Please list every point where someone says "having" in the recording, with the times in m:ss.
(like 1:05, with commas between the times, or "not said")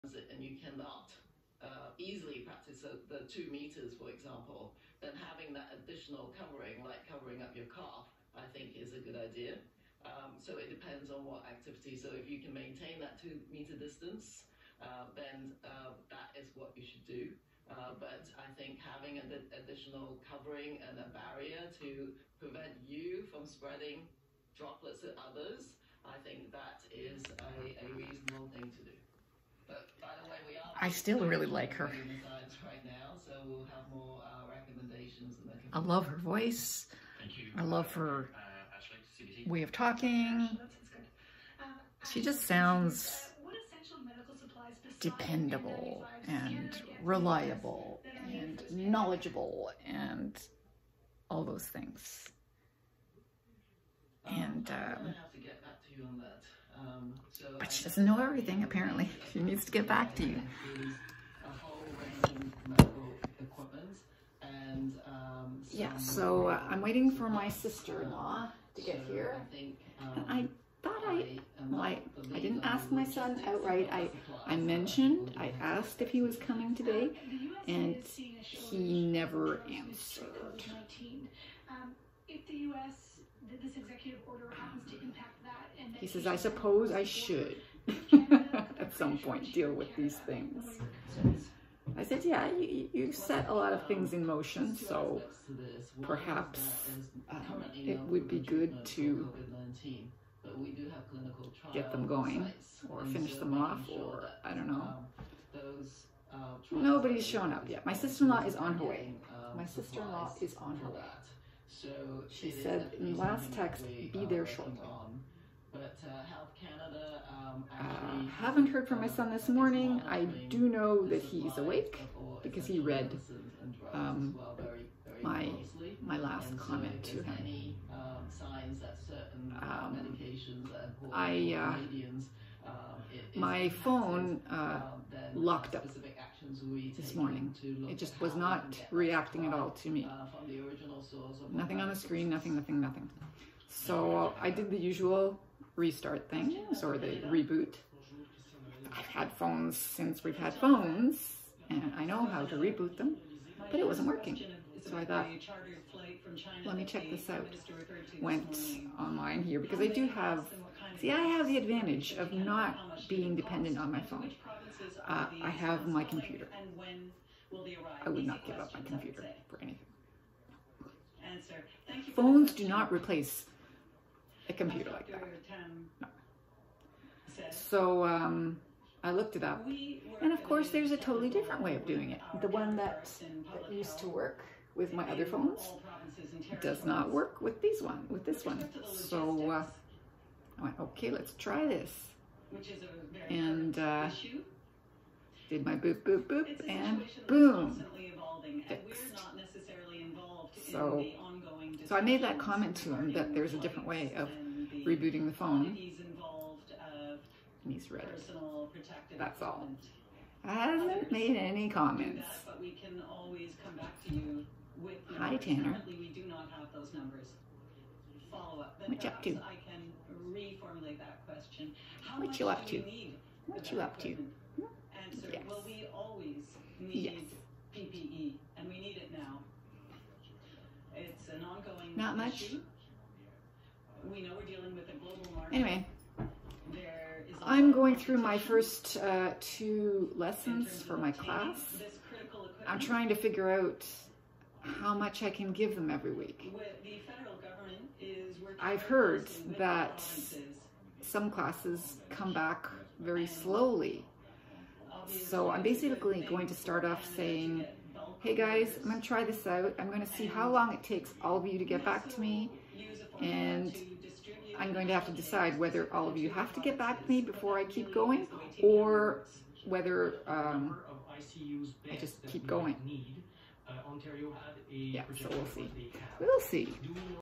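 0:05, 0:18.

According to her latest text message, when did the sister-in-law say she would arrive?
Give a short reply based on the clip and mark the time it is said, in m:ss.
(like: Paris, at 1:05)
Shortly, at 1:54.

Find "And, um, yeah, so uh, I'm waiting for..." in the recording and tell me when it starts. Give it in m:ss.
1:04.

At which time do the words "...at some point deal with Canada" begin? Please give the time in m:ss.
1:28.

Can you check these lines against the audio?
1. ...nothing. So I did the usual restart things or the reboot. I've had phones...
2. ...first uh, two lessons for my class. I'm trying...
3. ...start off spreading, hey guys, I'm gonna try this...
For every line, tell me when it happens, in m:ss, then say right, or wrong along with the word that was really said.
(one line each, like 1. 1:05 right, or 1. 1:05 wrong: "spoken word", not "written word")
1. 2:22 right
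2. 3:58 right
3. 4:16 wrong: "saying", not "spreading".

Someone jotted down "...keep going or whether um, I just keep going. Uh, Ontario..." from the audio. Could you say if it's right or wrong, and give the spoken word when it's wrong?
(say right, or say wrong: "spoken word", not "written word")
right.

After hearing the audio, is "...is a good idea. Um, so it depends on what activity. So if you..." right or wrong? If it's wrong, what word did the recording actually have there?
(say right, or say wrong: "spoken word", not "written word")
right.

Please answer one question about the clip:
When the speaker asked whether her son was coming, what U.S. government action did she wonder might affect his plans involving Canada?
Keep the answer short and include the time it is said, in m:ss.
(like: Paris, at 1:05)
executive order, at 1:23.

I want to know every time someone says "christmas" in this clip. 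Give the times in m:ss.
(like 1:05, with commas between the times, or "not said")
not said.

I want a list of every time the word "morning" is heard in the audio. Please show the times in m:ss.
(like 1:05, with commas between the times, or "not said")
1:59, 2:17.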